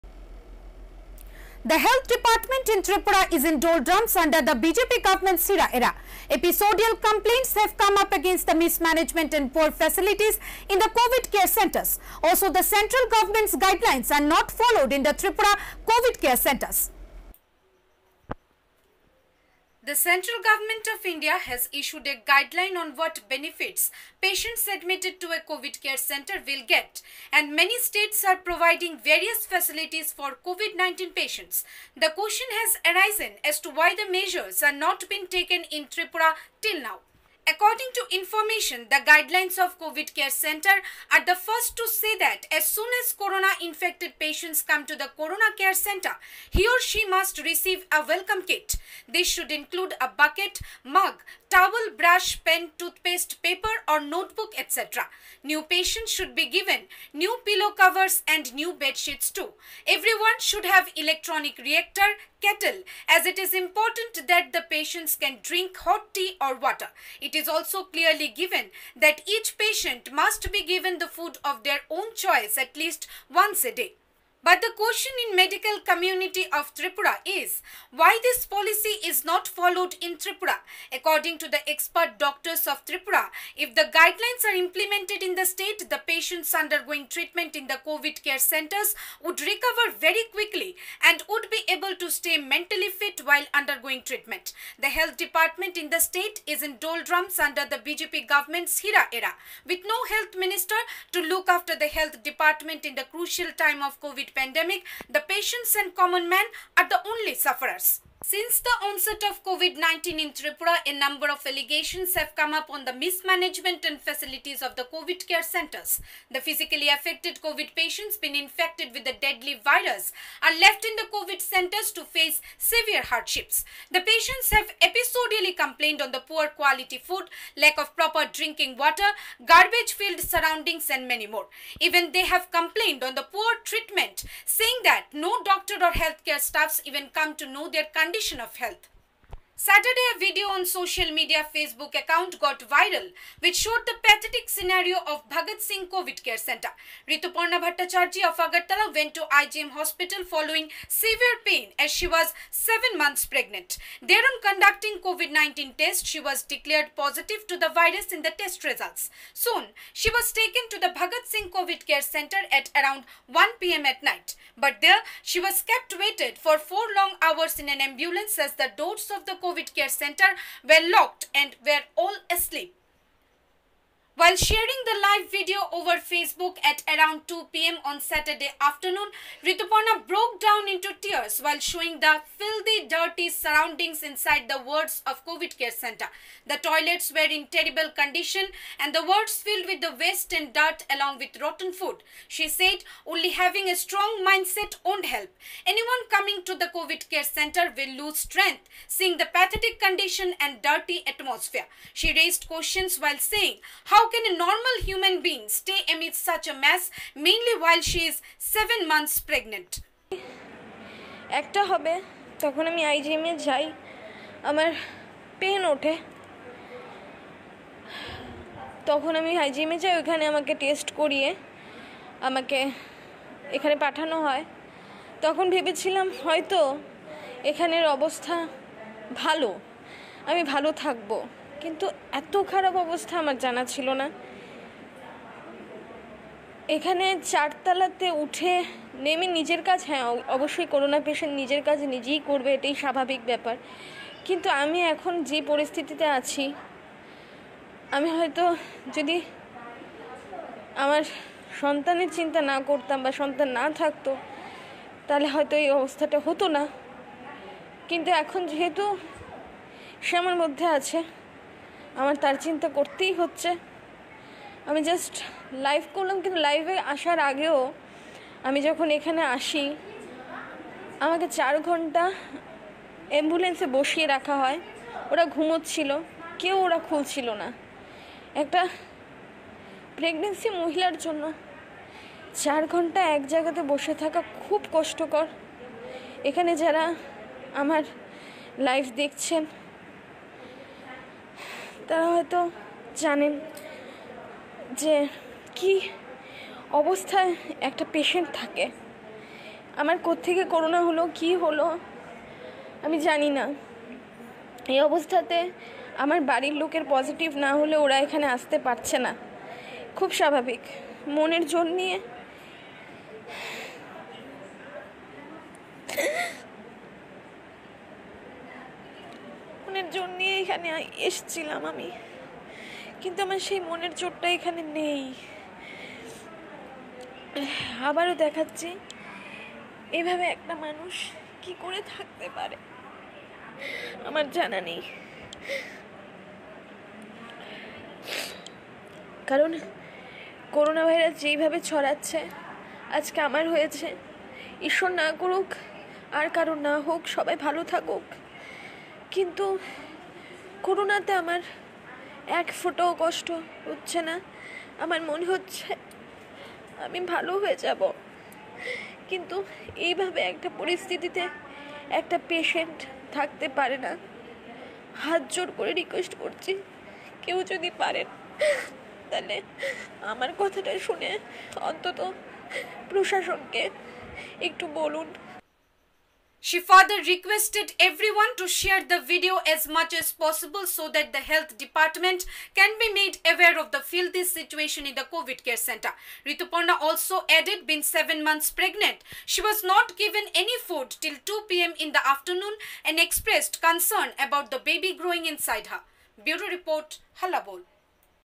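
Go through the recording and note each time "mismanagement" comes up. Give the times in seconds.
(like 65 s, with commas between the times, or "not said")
8 s, 112 s.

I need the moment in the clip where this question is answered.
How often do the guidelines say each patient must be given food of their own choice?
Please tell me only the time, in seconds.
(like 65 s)
73 s.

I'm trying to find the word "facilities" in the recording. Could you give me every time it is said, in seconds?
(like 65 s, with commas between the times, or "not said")
9 s, 29 s, 113 s.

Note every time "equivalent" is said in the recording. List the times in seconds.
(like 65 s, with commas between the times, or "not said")
not said.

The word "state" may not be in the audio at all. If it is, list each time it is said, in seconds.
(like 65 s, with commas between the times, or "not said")
27 s, 85 s, 95 s.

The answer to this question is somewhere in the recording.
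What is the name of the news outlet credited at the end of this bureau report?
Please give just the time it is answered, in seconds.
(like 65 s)
397 s.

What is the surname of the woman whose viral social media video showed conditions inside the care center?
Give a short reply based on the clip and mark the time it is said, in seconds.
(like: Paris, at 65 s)
Bhattacharjee, at 147 s.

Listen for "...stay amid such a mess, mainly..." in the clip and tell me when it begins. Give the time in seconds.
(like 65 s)
205 s.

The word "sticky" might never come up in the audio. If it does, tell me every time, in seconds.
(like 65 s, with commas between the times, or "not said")
not said.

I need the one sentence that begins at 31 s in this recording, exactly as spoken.
The question has arisen as to why the measures are not being taken in Tripura till now.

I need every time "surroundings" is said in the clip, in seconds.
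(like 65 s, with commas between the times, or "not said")
130 s, 183 s.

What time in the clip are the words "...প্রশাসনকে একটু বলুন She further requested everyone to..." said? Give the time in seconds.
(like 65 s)
372 s.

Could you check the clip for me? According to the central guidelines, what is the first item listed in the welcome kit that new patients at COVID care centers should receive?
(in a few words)
Bucket.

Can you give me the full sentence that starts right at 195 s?
Anyone coming to the COVID care center will lose strength seeing the pathetic condition and dirty atmosphere.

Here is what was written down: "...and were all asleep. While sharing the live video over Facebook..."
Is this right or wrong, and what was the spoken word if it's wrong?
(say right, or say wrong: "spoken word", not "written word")
right.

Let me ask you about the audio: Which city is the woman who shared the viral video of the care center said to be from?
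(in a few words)
Agartala.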